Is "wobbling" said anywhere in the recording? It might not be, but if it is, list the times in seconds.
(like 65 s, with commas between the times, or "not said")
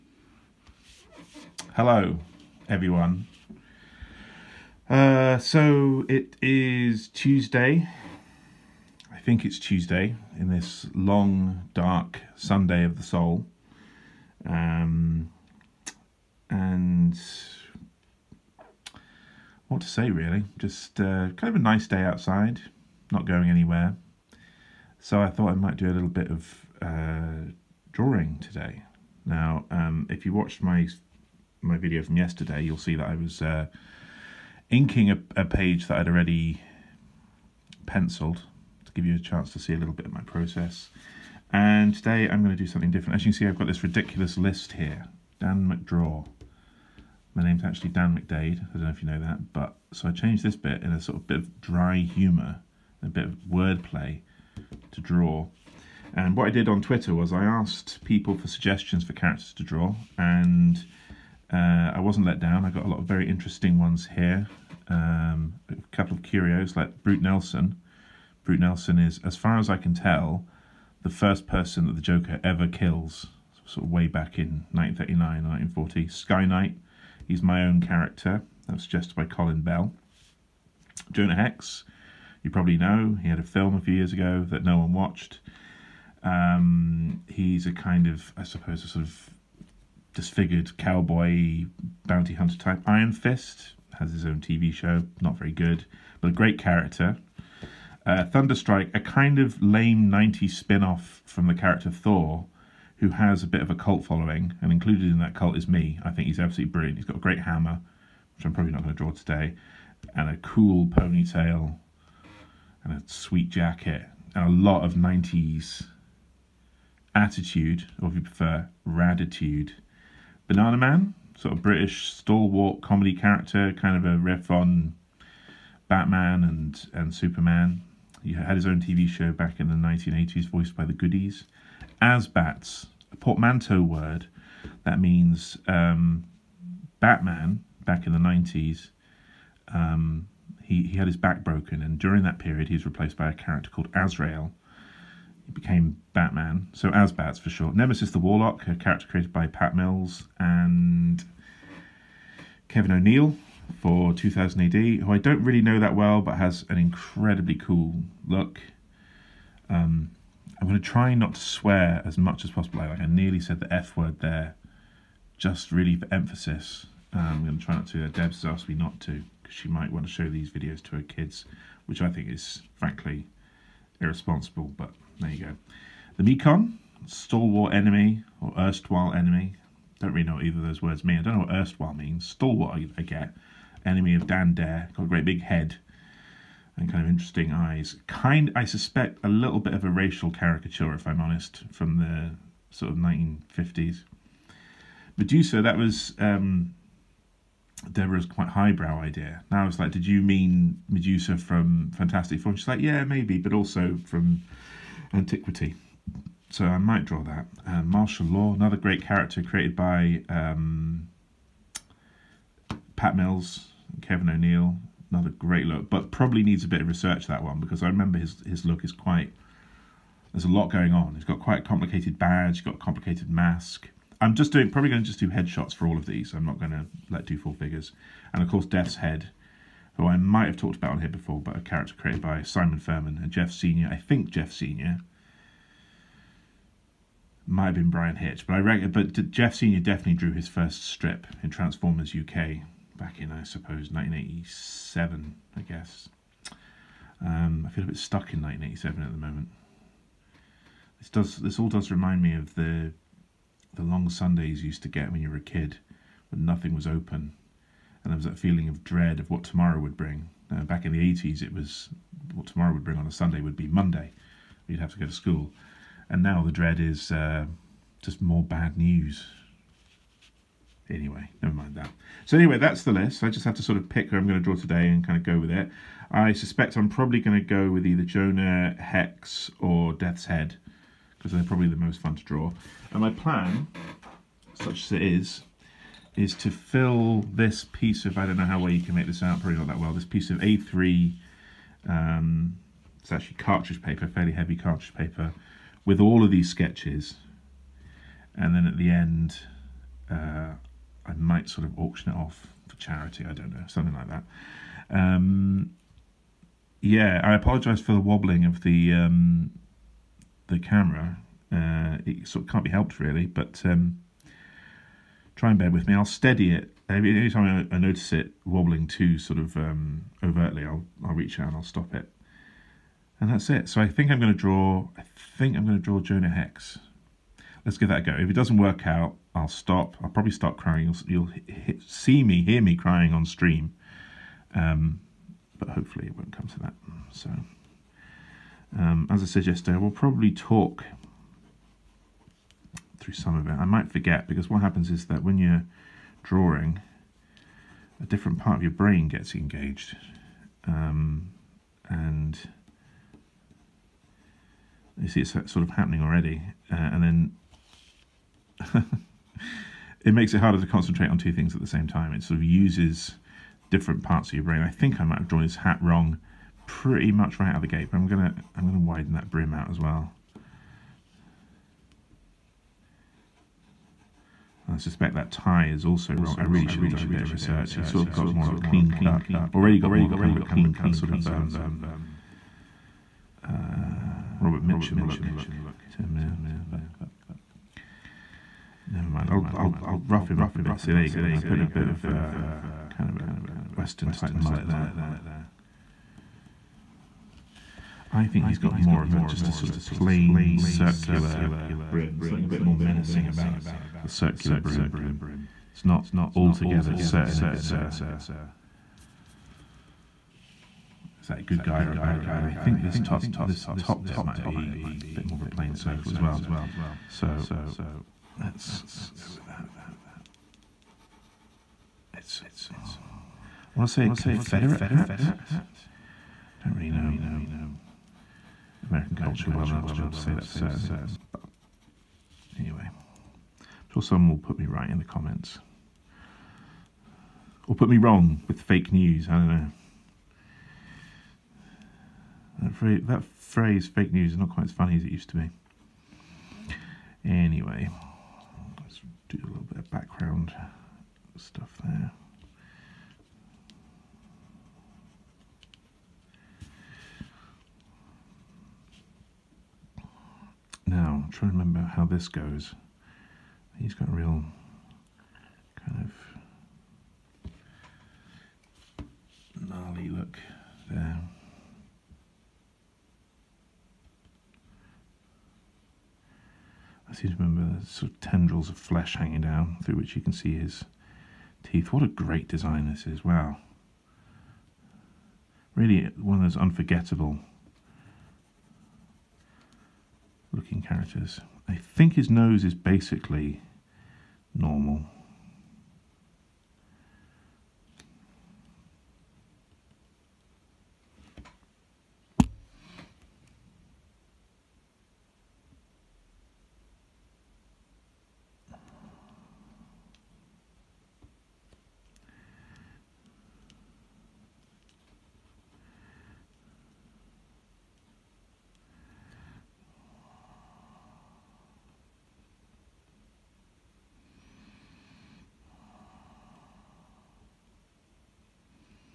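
308 s, 318 s.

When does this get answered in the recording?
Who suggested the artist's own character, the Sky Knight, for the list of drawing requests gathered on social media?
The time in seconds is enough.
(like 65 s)
79 s.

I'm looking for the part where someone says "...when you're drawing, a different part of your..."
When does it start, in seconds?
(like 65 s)
345 s.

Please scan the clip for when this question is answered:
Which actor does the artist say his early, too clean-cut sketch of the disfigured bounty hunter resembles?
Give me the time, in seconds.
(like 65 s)
384 s.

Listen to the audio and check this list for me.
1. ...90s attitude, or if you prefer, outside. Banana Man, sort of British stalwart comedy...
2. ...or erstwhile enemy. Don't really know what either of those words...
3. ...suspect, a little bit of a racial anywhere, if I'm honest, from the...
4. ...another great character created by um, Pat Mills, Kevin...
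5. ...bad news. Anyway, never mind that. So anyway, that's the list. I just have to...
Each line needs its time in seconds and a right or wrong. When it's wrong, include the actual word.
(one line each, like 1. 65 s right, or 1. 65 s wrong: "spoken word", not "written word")
1. 114 s wrong: "raditude", not "outside"
2. 178 s right
3. 188 s wrong: "caricature", not "anywhere"
4. 208 s right
5. 268 s right.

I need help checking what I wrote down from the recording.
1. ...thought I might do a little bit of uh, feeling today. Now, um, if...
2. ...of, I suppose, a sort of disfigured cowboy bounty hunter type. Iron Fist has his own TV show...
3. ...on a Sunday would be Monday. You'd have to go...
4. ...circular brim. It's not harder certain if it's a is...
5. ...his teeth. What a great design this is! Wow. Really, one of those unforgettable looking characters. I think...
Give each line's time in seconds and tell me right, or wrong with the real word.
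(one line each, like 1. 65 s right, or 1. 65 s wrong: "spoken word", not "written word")
1. 25 s wrong: "drawing", not "feeling"
2. 88 s right
3. 262 s right
4. 404 s wrong: "altogether", not "harder"
5. 480 s right.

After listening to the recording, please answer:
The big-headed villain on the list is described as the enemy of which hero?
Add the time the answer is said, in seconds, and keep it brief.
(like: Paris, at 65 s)
Dan Dare, at 184 s.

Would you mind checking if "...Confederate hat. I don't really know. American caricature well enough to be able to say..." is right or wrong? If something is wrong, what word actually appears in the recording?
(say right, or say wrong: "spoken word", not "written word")
wrong: "culture", not "caricature".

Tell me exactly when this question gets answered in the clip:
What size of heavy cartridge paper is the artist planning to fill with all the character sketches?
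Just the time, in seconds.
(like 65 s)
290 s.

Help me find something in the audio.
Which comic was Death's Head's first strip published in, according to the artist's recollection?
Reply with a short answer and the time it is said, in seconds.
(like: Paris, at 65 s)
Transformers UK, at 241 s.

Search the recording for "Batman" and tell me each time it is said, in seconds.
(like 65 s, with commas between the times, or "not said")
125 s, 136 s, 146 s.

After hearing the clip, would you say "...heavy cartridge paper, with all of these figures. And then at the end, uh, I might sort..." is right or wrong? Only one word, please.
wrong.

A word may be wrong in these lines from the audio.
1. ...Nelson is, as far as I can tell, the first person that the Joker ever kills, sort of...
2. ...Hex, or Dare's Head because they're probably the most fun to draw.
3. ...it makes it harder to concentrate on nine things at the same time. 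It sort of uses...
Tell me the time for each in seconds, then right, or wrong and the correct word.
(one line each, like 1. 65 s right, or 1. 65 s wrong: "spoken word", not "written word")
1. 68 s right
2. 278 s wrong: "Death", not "Dare"
3. 360 s wrong: "two", not "nine".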